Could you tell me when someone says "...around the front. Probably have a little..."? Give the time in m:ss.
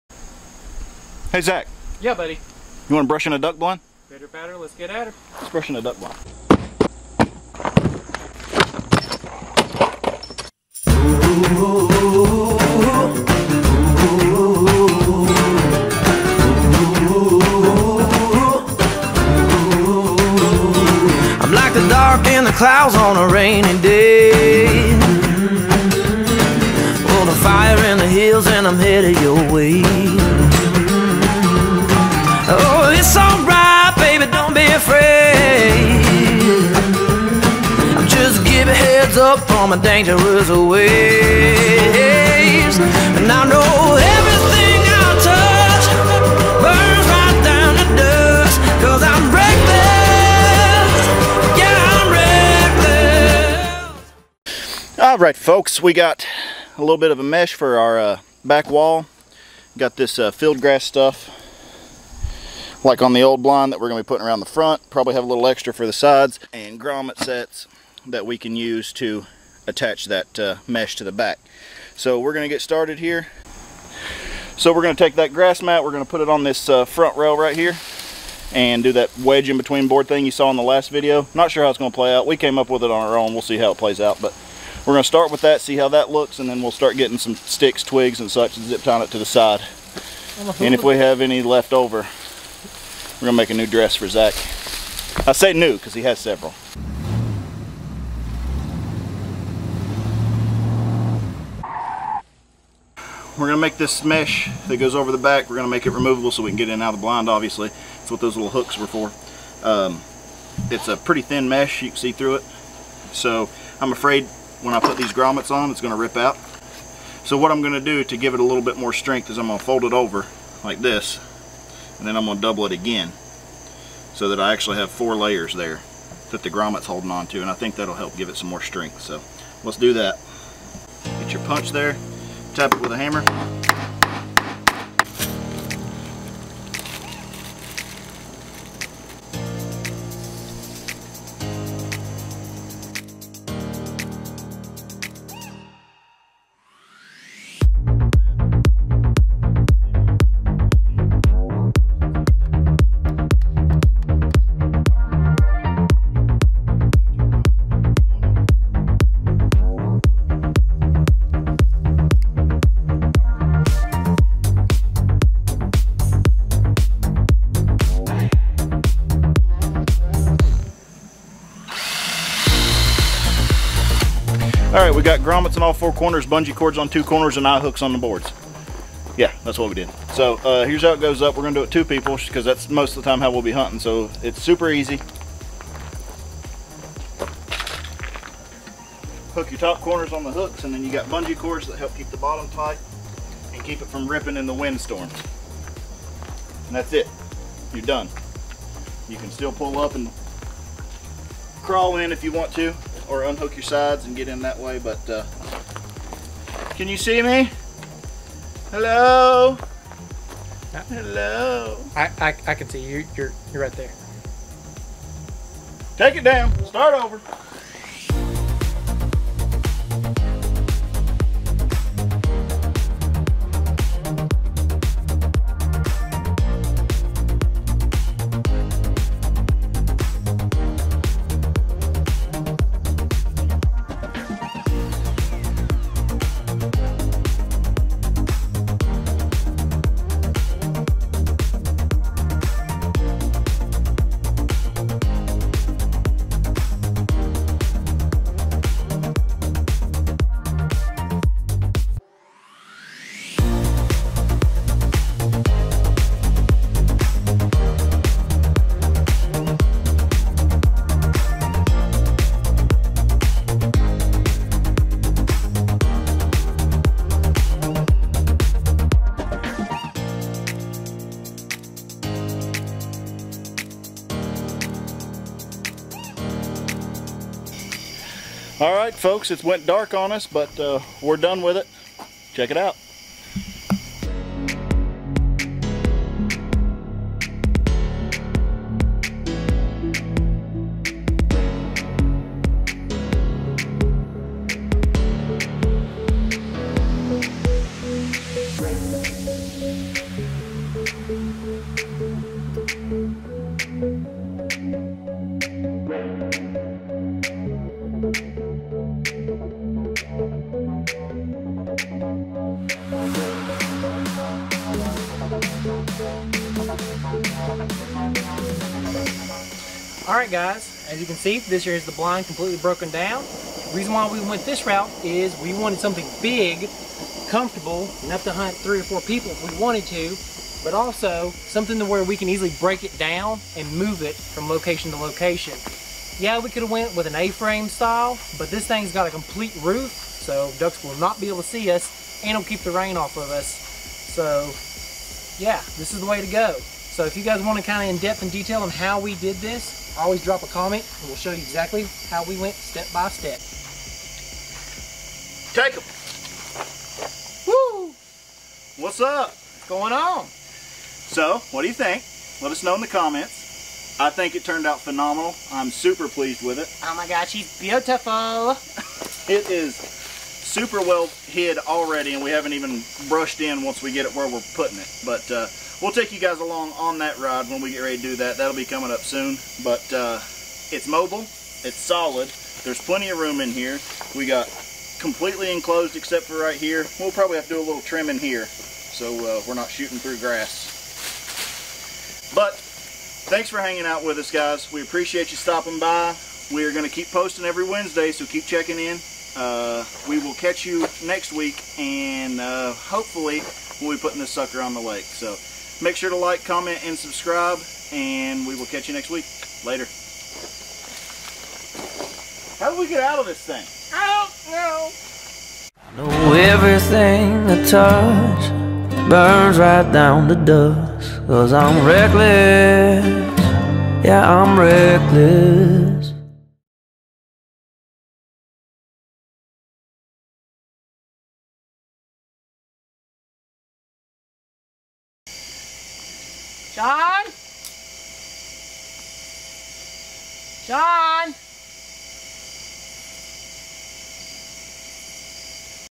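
1:04.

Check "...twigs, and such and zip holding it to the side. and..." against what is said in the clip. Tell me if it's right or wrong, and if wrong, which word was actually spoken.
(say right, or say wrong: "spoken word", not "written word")
wrong: "tying", not "holding".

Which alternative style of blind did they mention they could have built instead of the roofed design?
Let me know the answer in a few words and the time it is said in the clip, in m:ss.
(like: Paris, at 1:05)
A-frame, at 5:37.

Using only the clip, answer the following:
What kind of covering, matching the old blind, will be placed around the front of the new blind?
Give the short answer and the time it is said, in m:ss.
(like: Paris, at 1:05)
field grass, at 1:00.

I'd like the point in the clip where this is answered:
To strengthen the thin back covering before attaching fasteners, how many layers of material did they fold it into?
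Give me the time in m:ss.
2:04.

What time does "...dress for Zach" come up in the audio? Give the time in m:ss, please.
1:33.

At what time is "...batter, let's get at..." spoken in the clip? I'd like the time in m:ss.
0:04.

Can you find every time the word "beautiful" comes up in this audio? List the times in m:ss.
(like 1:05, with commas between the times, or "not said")
6:07.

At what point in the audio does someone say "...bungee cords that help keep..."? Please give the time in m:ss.
3:11.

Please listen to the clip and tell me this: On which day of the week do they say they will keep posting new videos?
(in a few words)
Wednesday.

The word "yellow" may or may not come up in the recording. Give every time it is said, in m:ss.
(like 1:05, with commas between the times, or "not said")
not said.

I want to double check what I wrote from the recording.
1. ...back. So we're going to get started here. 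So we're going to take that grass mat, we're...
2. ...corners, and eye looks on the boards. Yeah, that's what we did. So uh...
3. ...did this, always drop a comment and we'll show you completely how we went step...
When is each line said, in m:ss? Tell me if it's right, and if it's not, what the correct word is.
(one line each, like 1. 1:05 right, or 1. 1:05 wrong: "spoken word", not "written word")
1. 1:11 right
2. 2:57 wrong: "hooks", not "looks"
3. 5:49 wrong: "exactly", not "completely".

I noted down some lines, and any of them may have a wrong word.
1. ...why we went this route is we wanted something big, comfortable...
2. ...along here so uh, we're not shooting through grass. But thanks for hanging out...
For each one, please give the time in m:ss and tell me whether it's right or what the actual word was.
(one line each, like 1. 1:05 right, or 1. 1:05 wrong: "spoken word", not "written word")
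1. 5:23 right
2. 6:27 wrong: "trimming", not "along".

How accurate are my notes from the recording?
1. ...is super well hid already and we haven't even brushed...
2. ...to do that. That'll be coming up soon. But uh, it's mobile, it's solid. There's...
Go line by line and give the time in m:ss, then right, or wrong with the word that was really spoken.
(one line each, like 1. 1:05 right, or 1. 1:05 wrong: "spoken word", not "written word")
1. 6:09 right
2. 6:17 right.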